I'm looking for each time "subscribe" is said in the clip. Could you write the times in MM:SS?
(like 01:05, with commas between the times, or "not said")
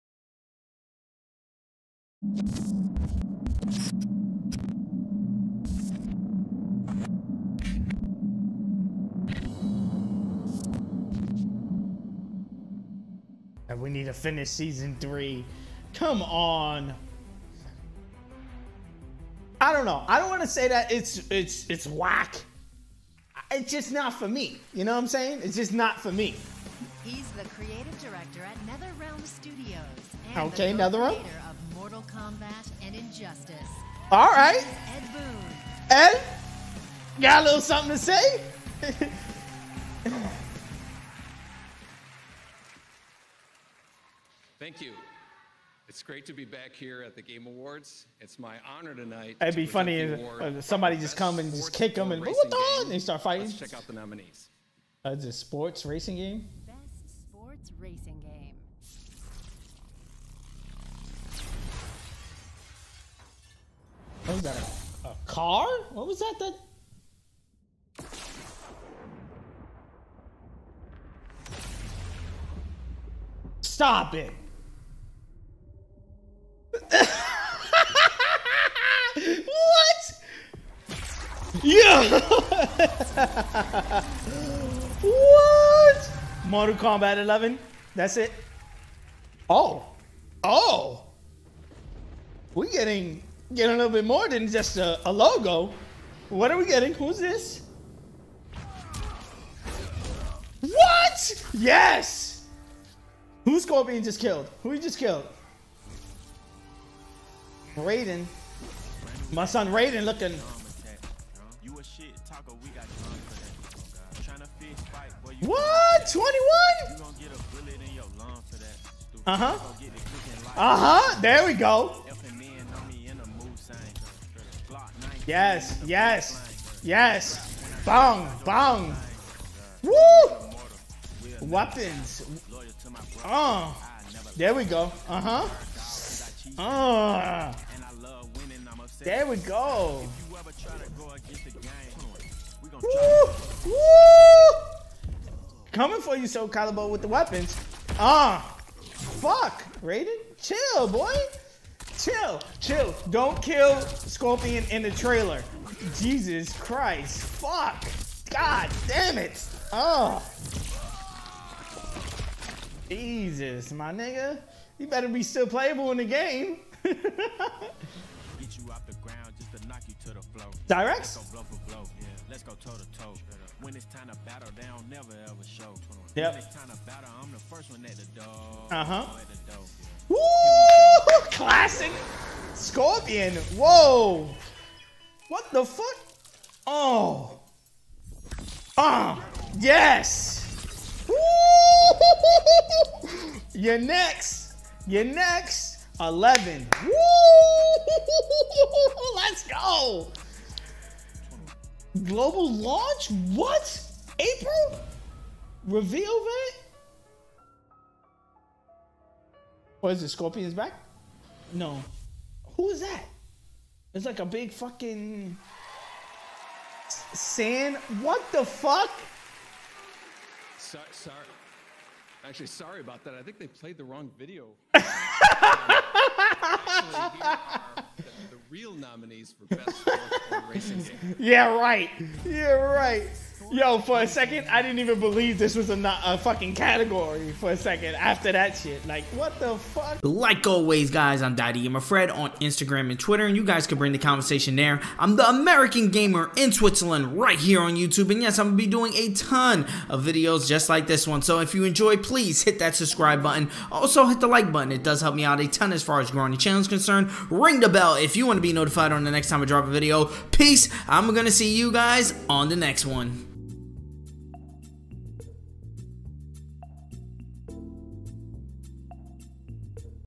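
04:12.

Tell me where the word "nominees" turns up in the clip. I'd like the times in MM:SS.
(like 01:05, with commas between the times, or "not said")
00:53, 03:48.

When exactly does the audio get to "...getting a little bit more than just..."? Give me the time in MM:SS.
01:33.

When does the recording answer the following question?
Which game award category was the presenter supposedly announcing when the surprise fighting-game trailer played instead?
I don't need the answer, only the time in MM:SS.
03:49.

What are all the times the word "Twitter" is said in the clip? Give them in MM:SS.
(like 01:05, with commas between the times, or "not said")
04:02.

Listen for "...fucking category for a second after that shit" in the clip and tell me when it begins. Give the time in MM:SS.
03:56.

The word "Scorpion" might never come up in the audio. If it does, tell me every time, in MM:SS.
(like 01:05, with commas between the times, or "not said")
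01:43, 02:33, 03:02, 03:30.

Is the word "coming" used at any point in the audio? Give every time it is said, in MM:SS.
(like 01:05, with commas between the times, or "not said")
02:25.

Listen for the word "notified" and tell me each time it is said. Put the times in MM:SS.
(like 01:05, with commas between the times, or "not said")
04:18.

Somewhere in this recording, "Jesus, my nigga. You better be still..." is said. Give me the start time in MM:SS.
02:42.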